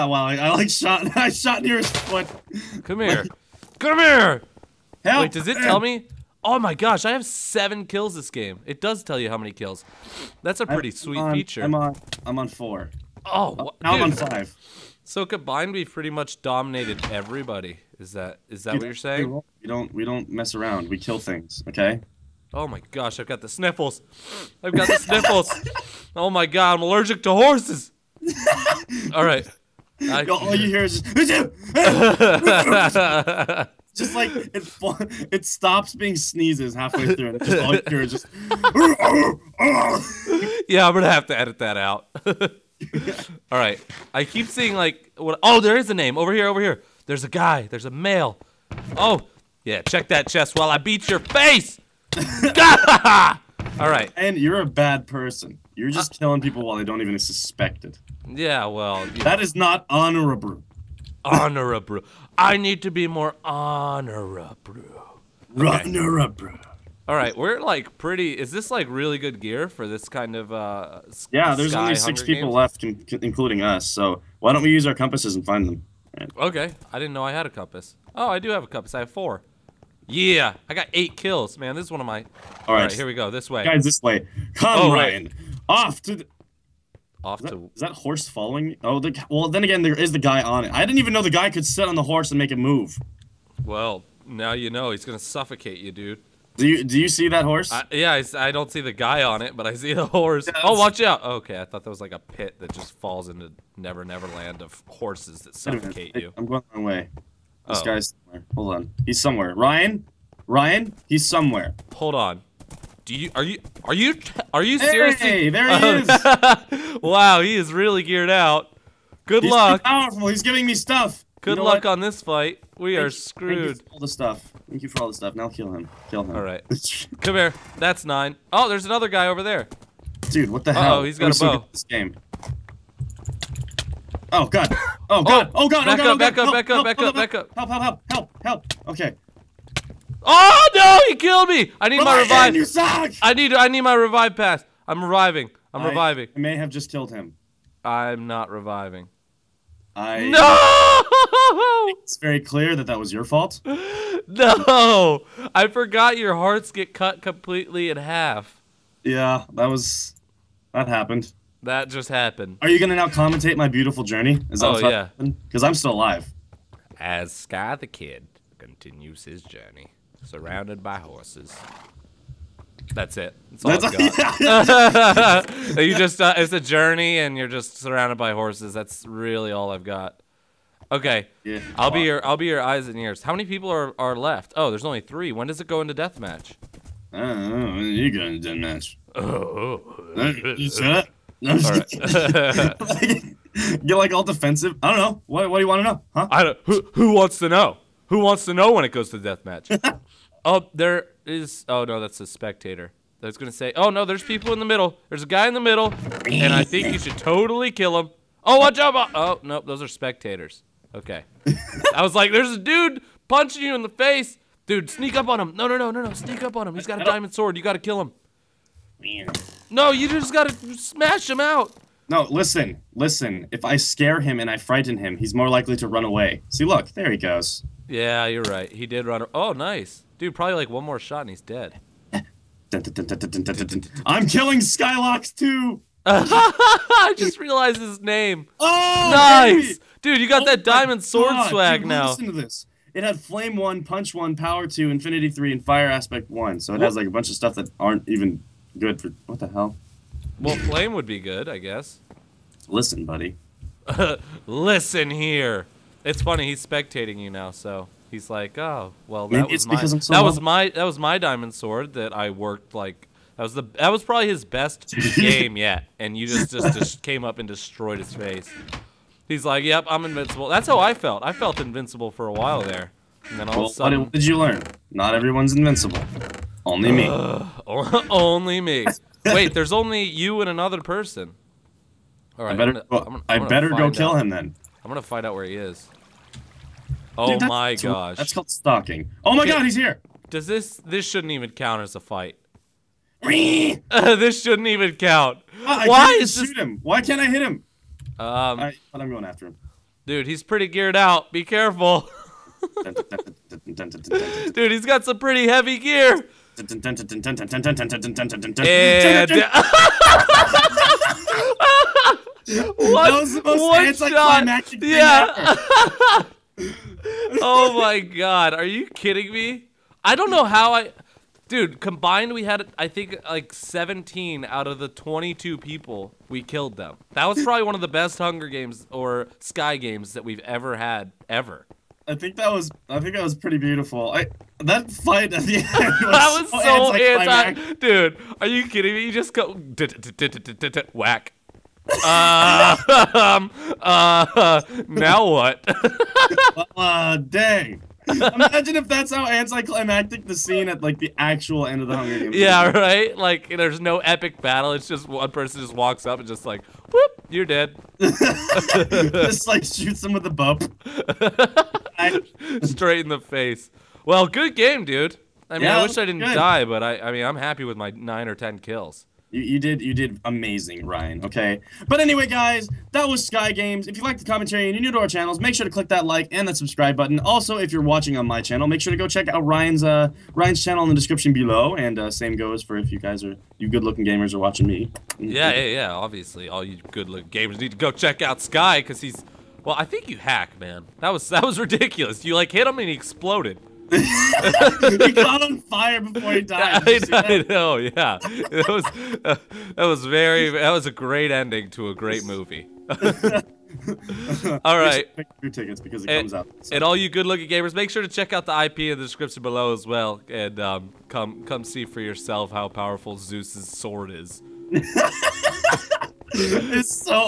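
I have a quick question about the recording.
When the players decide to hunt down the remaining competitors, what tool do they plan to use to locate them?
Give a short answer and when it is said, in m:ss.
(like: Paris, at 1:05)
Compasses, at 1:14.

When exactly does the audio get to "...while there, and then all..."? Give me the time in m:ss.
4:32.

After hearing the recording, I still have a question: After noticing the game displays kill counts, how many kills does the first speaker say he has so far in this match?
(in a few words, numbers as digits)
7.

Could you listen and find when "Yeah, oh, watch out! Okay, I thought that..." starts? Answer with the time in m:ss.
1:40.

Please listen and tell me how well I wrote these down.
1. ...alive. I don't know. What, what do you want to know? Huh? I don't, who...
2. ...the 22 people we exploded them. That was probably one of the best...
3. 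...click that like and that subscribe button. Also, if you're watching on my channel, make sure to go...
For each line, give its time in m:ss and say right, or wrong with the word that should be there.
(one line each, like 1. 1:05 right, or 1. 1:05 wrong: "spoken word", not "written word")
1. 3:14 wrong: "defensive", not "alive"
2. 5:24 wrong: "killed", not "exploded"
3. 6:15 right.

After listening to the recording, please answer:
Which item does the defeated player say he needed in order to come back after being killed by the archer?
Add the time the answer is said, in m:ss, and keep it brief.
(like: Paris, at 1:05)
Revive pass, at 2:23.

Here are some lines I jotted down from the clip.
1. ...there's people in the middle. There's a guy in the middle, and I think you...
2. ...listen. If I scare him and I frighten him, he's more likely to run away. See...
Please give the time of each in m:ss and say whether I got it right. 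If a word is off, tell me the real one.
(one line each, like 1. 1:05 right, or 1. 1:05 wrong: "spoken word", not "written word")
1. 3:24 right
2. 3:42 right.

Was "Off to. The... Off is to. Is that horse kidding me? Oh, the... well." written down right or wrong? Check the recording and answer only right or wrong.
wrong.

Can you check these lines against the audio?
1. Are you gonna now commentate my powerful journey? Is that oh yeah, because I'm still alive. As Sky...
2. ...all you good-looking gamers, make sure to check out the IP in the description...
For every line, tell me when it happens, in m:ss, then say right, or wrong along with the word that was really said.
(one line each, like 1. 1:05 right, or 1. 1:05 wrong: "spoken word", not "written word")
1. 2:42 wrong: "beautiful", not "powerful"
2. 6:46 right.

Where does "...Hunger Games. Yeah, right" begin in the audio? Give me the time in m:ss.
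5:51.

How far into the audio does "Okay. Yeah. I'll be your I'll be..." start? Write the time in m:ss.
3:00.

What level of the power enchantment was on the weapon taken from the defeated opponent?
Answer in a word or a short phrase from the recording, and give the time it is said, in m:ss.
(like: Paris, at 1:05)
2, at 4:04.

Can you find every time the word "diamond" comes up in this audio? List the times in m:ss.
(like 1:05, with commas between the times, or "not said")
3:37, 4:00, 4:21.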